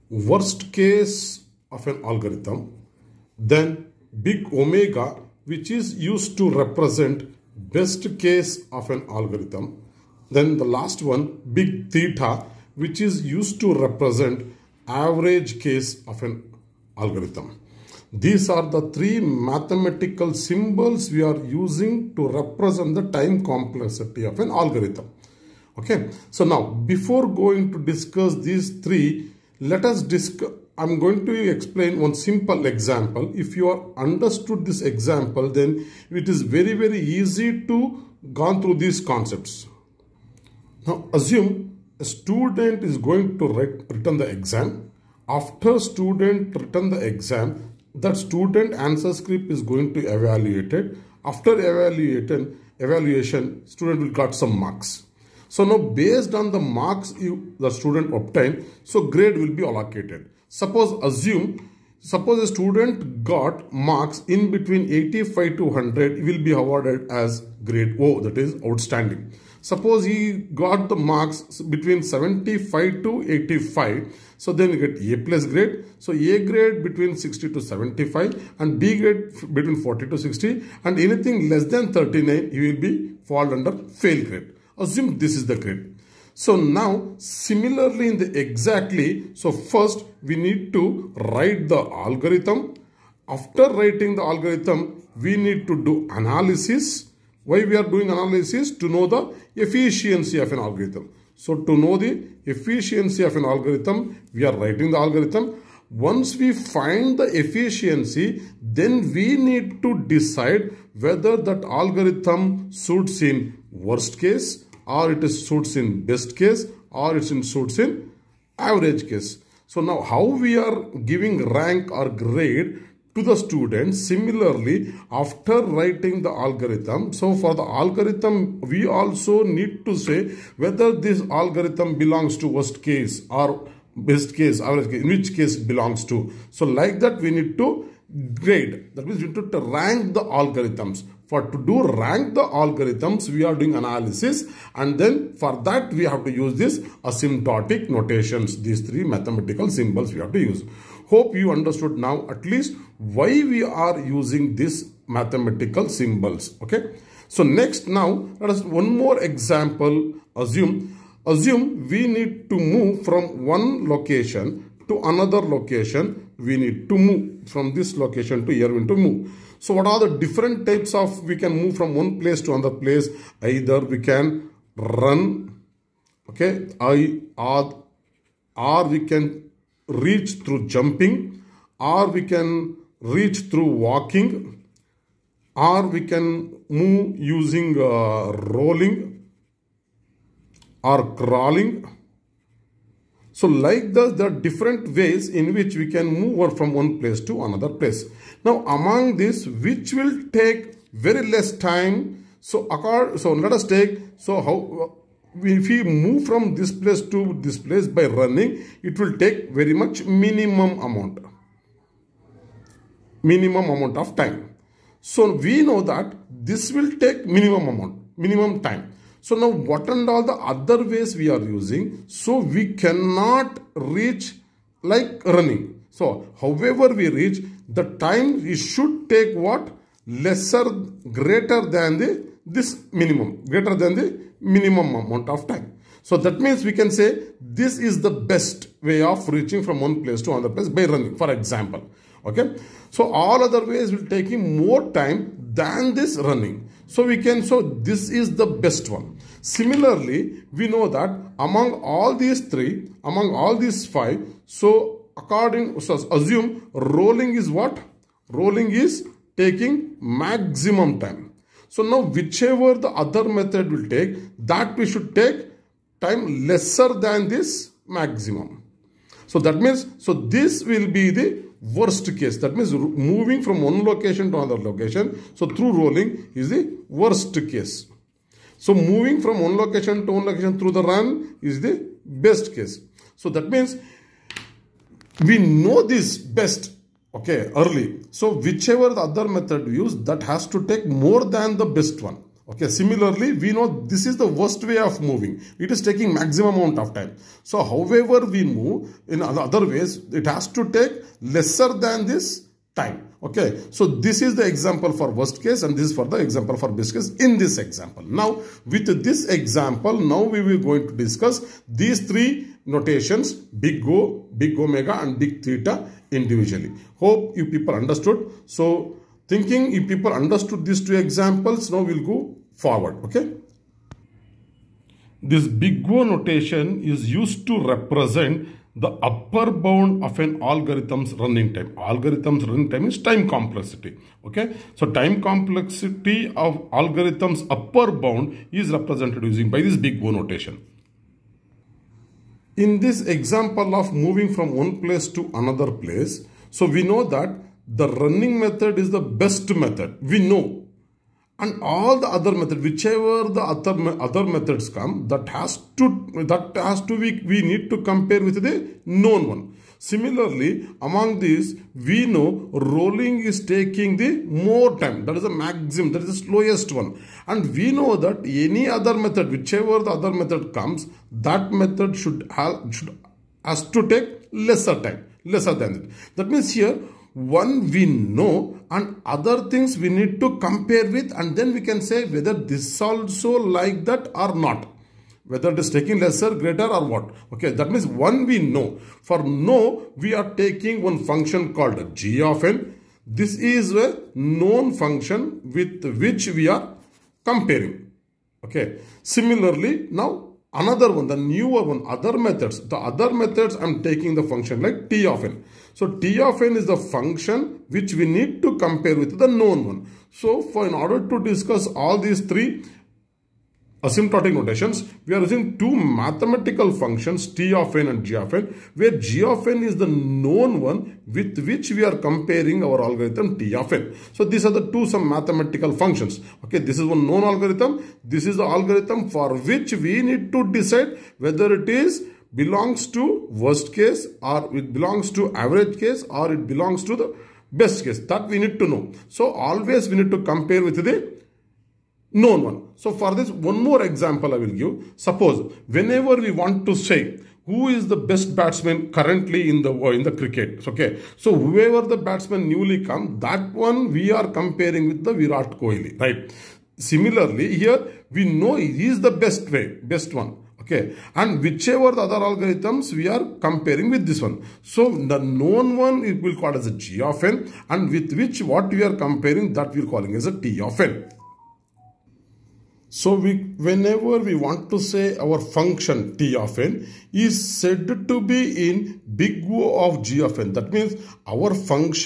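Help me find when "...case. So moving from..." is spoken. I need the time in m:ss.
4:37.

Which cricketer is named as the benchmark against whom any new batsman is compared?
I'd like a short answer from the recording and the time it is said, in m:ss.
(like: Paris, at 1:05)
Virat Kohli, at 7:35.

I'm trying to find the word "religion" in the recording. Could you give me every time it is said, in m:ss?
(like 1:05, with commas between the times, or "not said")
not said.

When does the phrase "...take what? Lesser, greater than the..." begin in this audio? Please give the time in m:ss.
3:49.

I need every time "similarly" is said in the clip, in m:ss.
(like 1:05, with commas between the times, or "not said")
1:27, 2:04, 4:09, 4:52, 5:59, 6:39, 7:36.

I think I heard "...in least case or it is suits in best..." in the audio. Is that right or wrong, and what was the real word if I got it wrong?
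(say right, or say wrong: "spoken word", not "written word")
wrong: "worst", not "least".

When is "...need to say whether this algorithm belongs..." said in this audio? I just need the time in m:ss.
2:09.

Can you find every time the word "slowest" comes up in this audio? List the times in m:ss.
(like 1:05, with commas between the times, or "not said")
6:06.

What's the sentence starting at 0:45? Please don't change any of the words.
After student return the exam, that student answer script is going to evaluate it.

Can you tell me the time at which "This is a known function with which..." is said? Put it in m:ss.
6:33.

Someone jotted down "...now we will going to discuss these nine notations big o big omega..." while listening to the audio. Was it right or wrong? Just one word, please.
wrong.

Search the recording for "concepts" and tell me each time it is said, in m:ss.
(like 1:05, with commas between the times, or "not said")
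0:39.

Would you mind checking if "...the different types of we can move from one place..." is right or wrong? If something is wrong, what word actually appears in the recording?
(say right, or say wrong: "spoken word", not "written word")
right.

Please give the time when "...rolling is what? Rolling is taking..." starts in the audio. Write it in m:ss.
4:16.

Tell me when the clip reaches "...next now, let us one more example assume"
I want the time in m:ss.
2:37.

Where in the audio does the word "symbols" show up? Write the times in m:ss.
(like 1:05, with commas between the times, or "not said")
0:20, 2:29, 2:35.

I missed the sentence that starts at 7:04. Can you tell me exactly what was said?
So these are the two some mathematical functions.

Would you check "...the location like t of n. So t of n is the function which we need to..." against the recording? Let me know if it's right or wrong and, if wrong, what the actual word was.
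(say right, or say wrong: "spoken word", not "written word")
wrong: "function", not "location".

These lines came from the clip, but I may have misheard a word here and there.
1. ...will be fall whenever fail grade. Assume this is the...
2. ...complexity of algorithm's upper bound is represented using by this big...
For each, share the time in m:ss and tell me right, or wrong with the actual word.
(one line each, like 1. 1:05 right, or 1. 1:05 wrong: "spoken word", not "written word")
1. 1:22 wrong: "under", not "whenever"
2. 5:35 right.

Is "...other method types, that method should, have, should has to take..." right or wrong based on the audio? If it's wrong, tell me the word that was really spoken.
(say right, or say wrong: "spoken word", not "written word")
wrong: "comes", not "types".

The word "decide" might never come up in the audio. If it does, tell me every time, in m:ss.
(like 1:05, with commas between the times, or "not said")
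1:50, 7:10.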